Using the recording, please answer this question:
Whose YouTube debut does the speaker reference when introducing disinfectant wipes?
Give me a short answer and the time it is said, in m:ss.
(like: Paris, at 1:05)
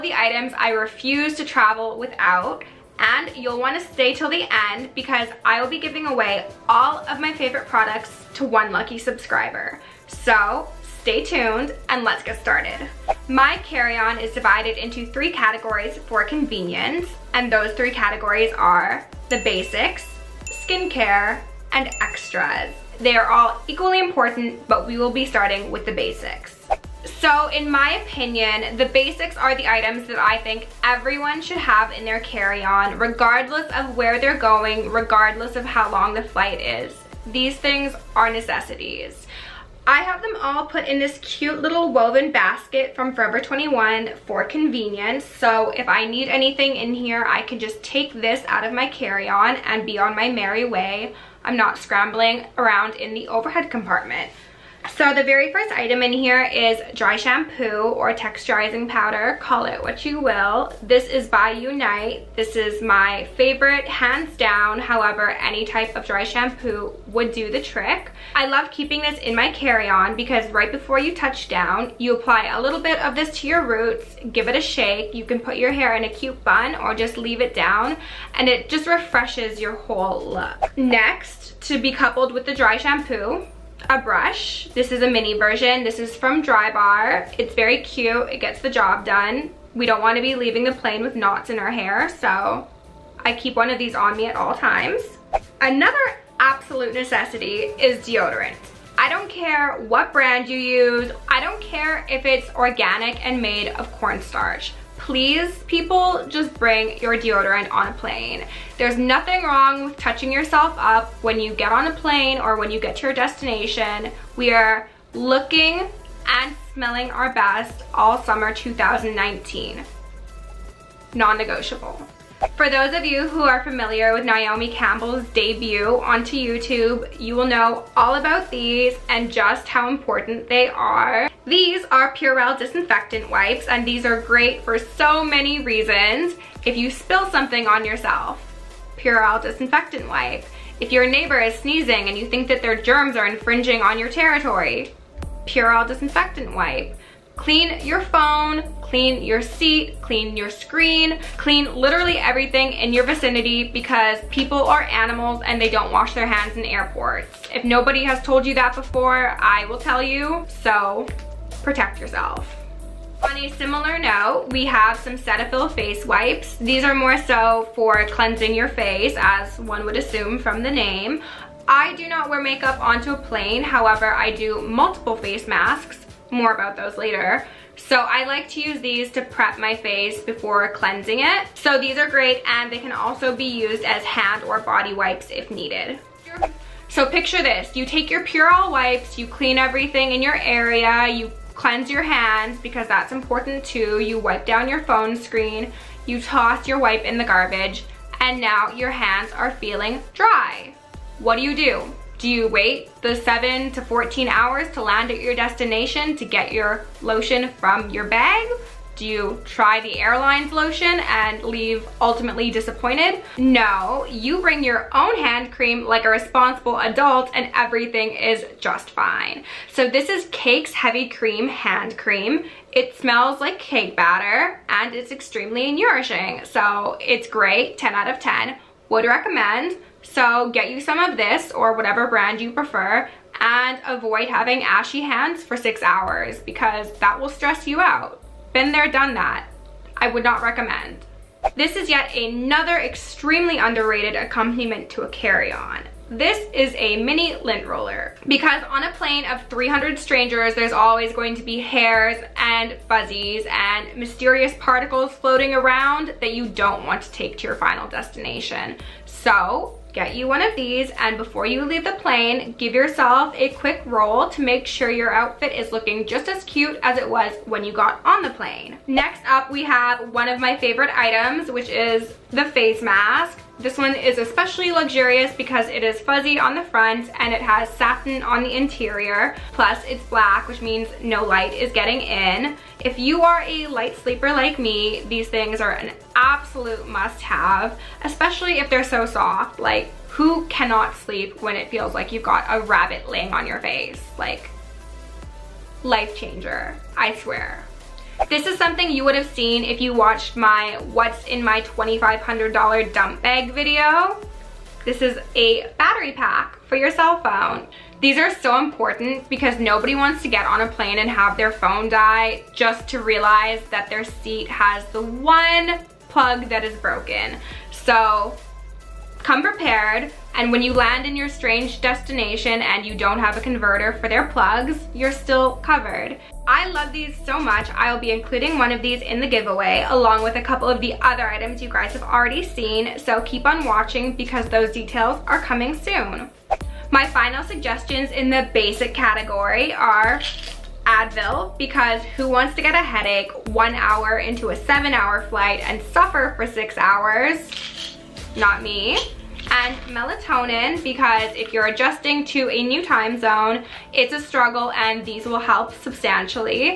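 Naomi Campbell, at 2:04.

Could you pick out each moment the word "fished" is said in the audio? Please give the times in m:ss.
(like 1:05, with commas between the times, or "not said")
not said.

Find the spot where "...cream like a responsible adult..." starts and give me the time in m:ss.
3:35.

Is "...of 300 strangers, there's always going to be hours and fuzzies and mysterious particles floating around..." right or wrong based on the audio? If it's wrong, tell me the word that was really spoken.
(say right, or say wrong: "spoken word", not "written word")
wrong: "hairs", not "hours".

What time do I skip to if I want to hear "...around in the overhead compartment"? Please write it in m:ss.
0:52.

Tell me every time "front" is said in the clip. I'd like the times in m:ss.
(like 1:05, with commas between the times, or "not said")
4:36.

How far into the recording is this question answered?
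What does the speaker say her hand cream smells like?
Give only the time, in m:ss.
3:43.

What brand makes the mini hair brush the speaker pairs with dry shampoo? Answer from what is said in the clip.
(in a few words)
Drybar.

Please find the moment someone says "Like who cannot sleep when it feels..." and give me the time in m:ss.
4:49.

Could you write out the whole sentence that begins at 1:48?
There's nothing wrong with touching yourself up when you get on a plane or when you get to your destination.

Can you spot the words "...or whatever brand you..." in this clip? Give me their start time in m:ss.
3:51.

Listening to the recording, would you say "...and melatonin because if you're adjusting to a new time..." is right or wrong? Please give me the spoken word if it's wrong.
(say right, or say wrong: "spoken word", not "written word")
right.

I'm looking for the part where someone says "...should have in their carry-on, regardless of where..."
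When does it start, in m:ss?
0:31.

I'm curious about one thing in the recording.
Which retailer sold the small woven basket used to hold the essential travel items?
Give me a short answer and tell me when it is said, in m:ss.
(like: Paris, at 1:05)
Forever 21, at 0:43.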